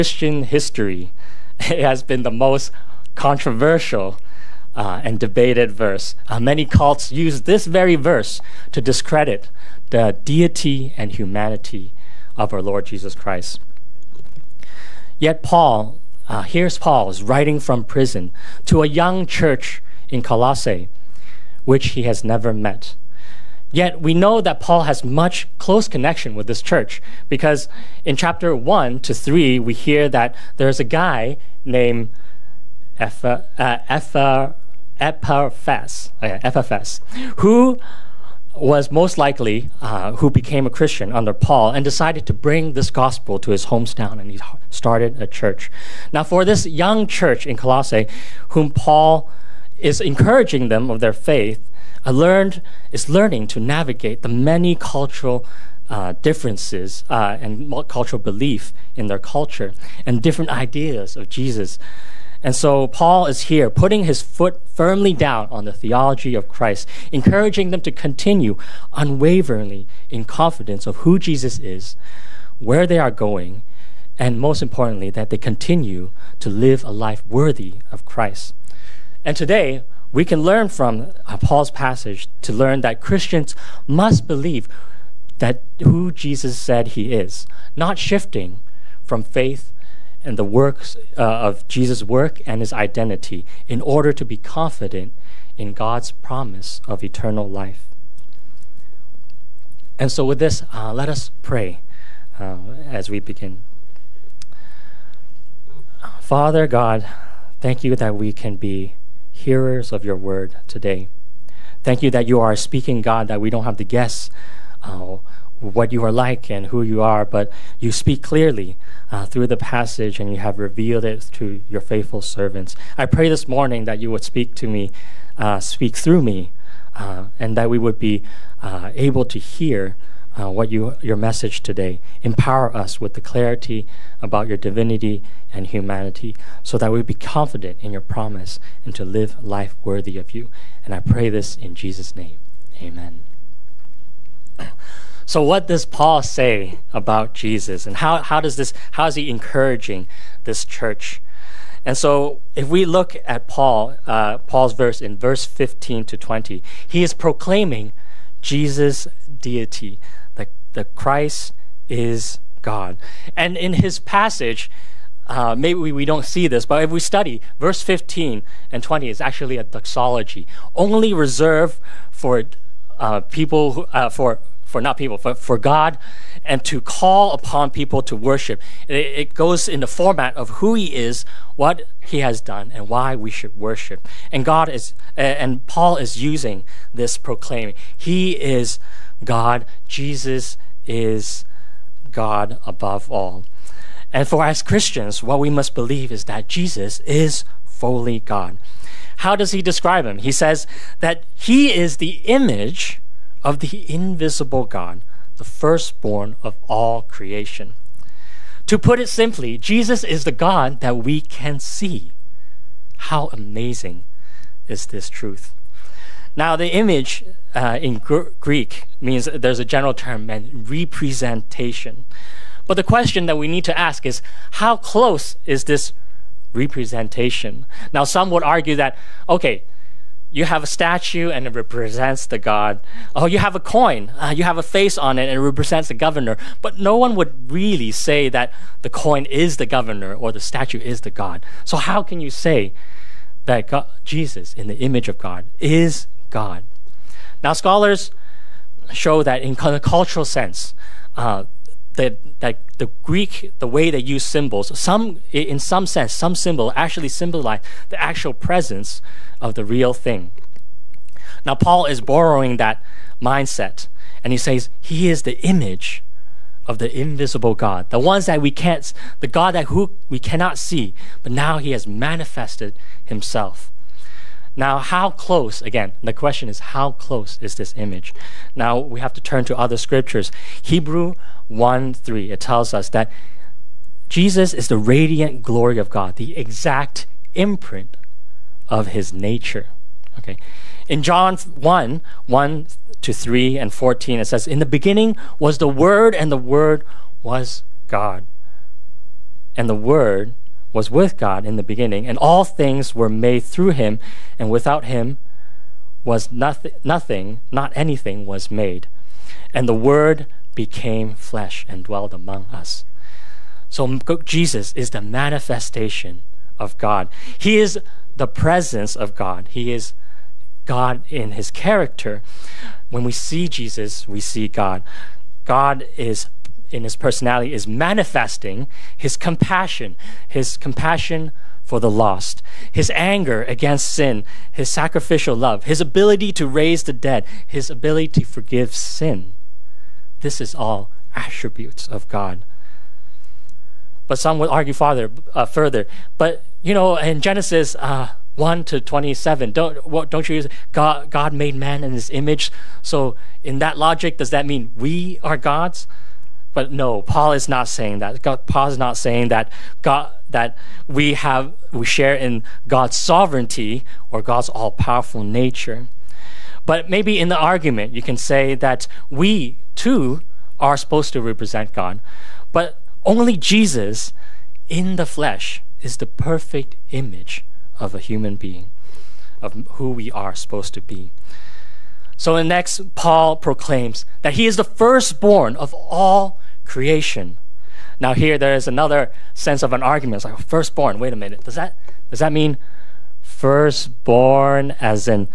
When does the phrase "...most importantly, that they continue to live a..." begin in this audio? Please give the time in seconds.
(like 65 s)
74 s.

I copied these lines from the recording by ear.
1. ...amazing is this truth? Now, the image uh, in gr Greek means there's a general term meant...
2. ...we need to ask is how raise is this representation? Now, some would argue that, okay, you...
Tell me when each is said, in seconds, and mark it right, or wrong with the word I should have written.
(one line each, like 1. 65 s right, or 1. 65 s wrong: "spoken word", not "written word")
1. 213 s right
2. 223 s wrong: "close", not "raise".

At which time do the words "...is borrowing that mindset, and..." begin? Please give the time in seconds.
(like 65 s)
261 s.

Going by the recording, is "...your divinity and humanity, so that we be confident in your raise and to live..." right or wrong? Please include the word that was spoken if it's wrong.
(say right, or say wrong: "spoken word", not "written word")
wrong: "promise", not "raise".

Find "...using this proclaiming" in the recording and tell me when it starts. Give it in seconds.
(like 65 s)
186 s.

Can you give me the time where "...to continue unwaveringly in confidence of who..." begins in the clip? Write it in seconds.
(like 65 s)
67 s.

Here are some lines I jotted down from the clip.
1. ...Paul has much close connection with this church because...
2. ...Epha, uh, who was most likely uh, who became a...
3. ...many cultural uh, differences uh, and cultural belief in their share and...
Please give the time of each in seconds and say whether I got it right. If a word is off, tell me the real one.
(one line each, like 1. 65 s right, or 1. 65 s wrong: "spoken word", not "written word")
1. 24 s right
2. 32 s right
3. 54 s wrong: "culture", not "share".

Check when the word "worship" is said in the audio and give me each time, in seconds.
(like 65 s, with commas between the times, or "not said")
178 s, 183 s.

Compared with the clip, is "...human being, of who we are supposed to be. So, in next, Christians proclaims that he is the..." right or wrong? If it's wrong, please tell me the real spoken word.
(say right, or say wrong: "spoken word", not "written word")
wrong: "Paul", not "Christians".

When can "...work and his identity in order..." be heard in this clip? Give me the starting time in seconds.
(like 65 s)
92 s.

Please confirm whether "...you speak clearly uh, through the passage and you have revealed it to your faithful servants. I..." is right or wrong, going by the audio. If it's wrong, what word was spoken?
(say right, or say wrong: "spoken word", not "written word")
right.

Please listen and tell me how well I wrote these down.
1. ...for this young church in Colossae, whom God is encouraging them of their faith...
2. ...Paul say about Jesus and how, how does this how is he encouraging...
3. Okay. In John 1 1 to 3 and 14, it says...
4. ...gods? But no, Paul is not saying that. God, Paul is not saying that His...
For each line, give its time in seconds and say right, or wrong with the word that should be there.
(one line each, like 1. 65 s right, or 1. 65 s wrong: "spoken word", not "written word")
1. 46 s wrong: "Paul", not "God"
2. 145 s right
3. 290 s right
4. 355 s wrong: "God", not "His".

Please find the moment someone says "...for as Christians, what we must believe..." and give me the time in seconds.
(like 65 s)
194 s.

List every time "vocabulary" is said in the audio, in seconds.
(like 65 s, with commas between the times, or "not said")
not said.